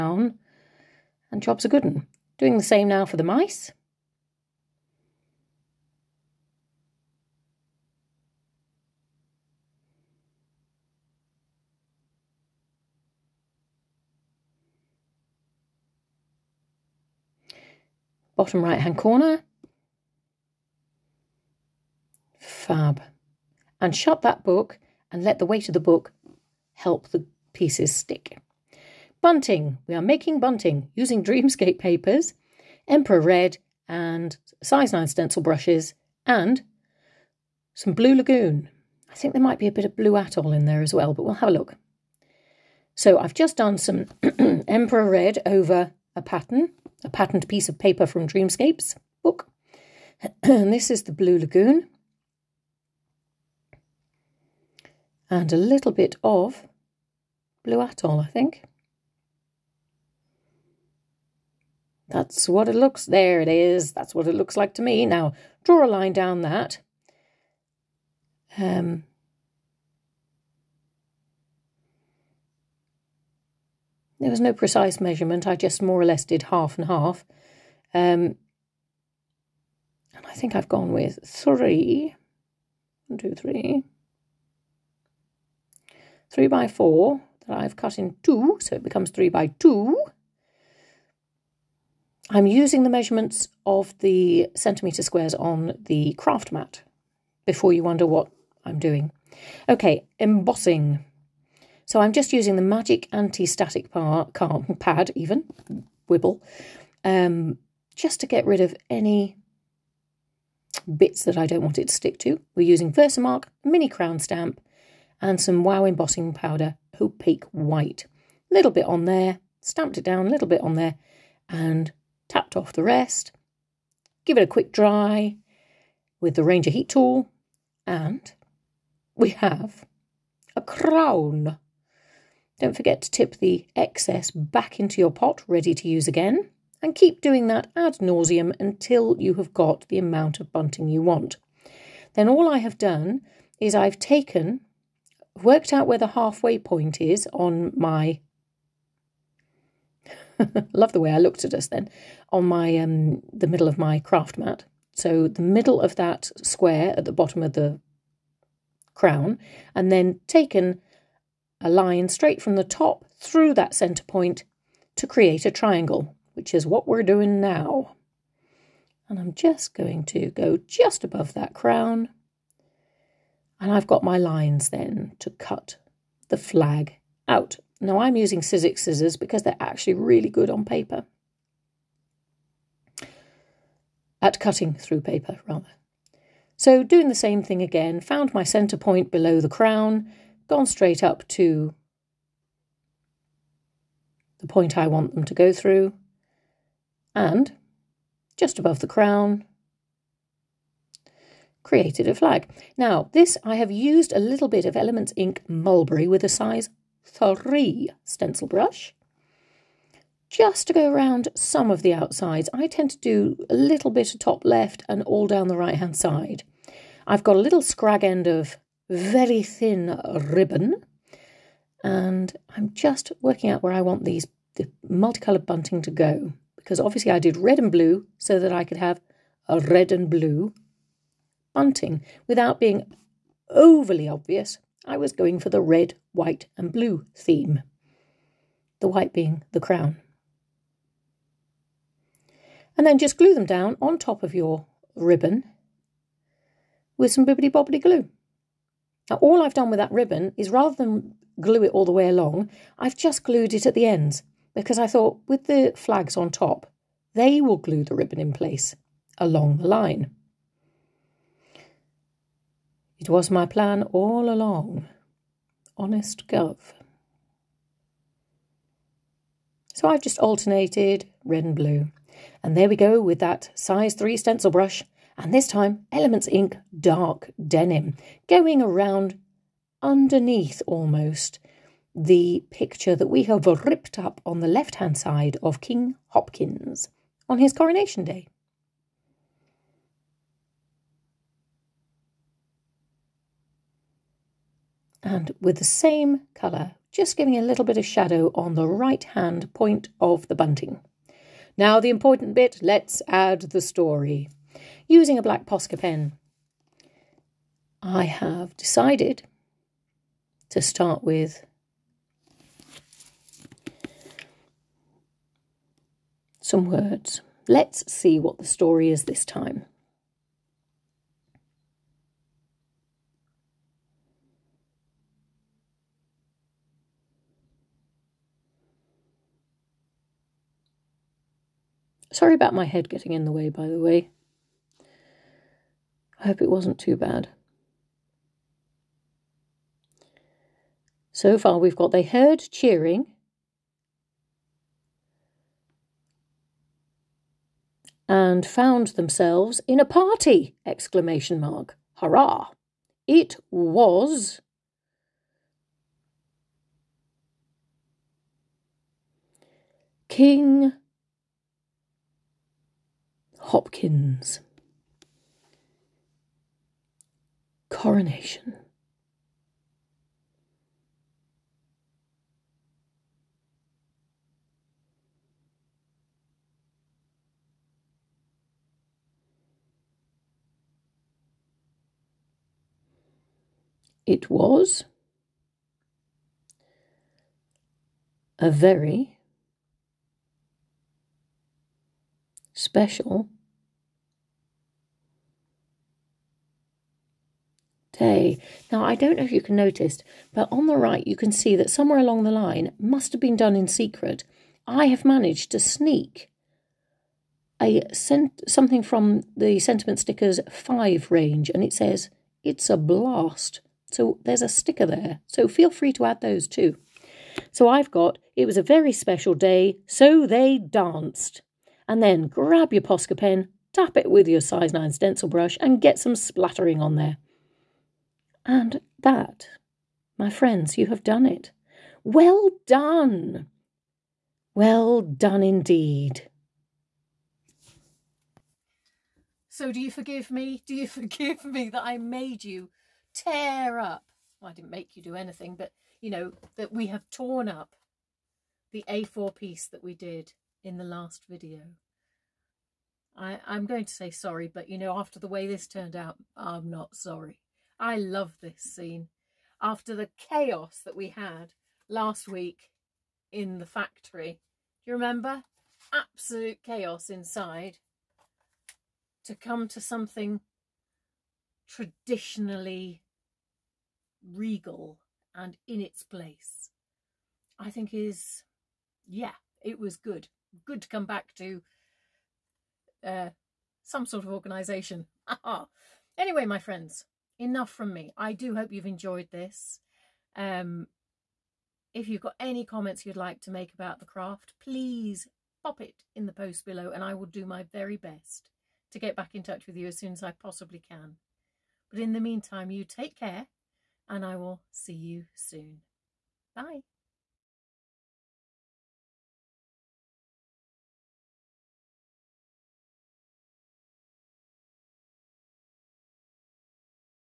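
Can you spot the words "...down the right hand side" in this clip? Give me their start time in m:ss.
3:35.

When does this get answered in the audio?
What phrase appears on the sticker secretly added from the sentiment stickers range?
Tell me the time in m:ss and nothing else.
6:52.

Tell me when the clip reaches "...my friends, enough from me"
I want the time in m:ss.
8:06.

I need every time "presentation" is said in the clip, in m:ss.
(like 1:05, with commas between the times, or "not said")
not said.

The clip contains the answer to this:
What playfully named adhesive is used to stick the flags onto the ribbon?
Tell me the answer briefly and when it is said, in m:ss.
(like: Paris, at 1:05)
bippity boppity glue, at 4:07.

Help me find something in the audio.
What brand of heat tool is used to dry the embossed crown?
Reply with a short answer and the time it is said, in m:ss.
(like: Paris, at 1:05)
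Ranger, at 2:06.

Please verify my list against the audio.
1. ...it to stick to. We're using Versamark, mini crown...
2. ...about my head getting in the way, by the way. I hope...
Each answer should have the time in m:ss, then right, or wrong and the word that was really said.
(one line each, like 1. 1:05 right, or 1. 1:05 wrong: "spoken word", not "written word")
1. 1:51 right
2. 5:32 right.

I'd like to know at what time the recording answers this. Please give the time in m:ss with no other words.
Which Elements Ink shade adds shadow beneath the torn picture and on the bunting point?
4:36.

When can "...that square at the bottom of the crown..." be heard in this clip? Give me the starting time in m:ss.
2:35.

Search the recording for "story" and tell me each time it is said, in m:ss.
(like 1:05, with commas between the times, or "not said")
5:03, 5:18.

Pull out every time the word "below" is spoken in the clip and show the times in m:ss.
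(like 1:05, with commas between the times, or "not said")
3:09, 8:16.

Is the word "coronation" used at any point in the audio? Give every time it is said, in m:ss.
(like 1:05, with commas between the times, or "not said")
4:47, 6:07.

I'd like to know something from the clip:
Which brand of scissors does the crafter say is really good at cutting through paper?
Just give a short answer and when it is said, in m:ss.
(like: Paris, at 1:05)
Sizzix, at 2:58.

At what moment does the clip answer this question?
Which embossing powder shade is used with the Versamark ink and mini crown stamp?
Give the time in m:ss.
1:56.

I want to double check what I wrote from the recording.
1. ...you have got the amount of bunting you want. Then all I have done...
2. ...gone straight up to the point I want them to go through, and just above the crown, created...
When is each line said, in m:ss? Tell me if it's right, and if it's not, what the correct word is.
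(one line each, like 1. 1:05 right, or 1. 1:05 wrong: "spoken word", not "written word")
1. 2:19 right
2. 3:10 right.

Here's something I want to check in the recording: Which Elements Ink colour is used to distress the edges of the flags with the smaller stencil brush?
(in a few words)
Mulberry.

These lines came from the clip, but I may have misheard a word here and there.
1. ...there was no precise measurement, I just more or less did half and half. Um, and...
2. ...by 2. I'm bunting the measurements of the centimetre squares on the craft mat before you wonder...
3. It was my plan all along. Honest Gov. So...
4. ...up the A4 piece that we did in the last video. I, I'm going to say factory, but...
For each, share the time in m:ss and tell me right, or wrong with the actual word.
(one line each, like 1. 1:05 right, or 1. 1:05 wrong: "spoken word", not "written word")
1. 1:14 right
2. 1:29 wrong: "using", not "bunting"
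3. 4:22 right
4. 7:27 wrong: "sorry", not "factory".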